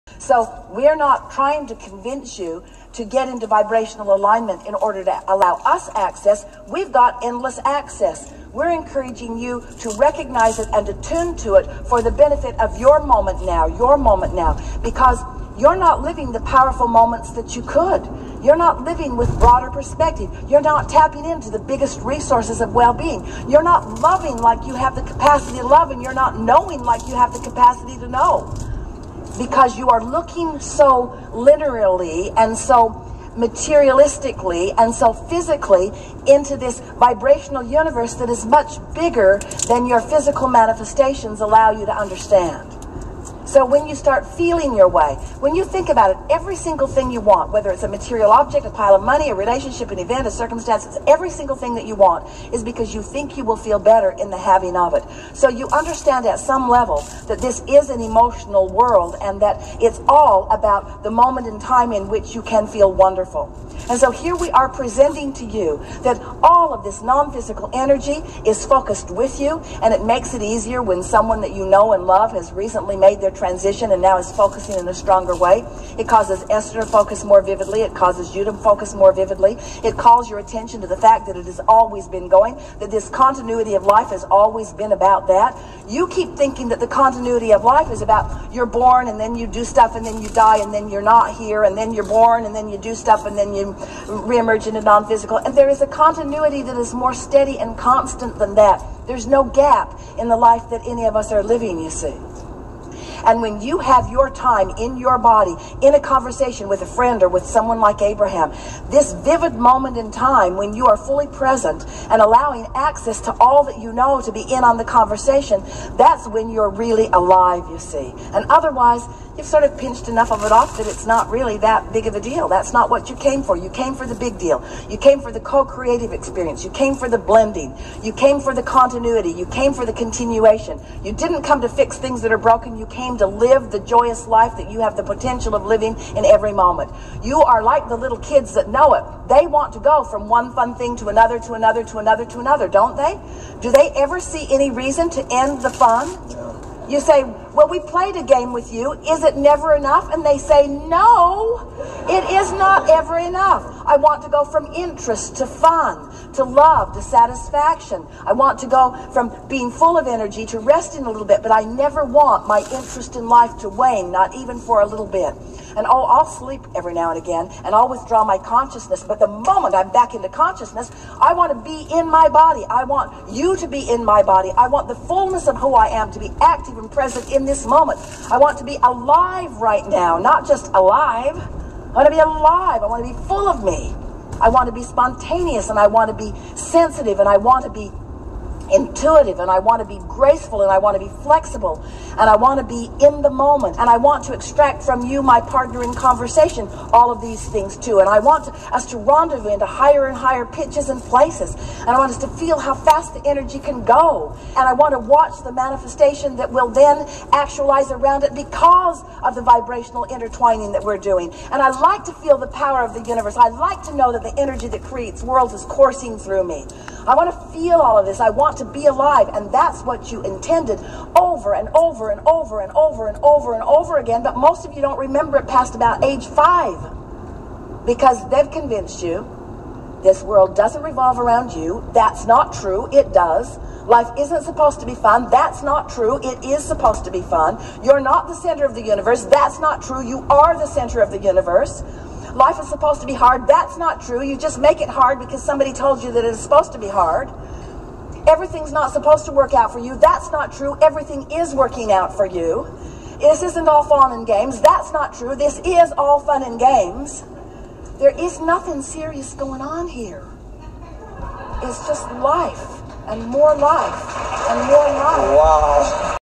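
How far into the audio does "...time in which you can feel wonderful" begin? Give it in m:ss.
1:01.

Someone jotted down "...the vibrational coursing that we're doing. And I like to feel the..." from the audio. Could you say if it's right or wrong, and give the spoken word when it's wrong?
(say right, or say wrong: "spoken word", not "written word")
wrong: "intertwining", not "coursing".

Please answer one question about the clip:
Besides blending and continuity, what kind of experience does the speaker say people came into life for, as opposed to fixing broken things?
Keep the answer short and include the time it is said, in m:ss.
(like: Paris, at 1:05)
co-creative experience, at 2:05.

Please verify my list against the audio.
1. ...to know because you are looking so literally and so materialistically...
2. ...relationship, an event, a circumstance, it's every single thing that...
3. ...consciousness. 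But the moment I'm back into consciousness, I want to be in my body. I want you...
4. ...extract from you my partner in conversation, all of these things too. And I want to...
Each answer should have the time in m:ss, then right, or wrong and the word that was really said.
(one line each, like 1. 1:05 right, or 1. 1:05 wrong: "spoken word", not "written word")
1. 0:27 right
2. 0:49 right
3. 2:48 right
4. 3:14 right.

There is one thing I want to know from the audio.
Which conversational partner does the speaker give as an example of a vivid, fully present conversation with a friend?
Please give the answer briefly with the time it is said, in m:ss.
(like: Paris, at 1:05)
Abraham, at 1:48.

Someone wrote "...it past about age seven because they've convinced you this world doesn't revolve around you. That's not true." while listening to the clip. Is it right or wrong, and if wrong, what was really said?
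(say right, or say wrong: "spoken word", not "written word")
wrong: "five", not "seven".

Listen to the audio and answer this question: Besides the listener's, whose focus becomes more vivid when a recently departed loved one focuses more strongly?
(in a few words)
Esther.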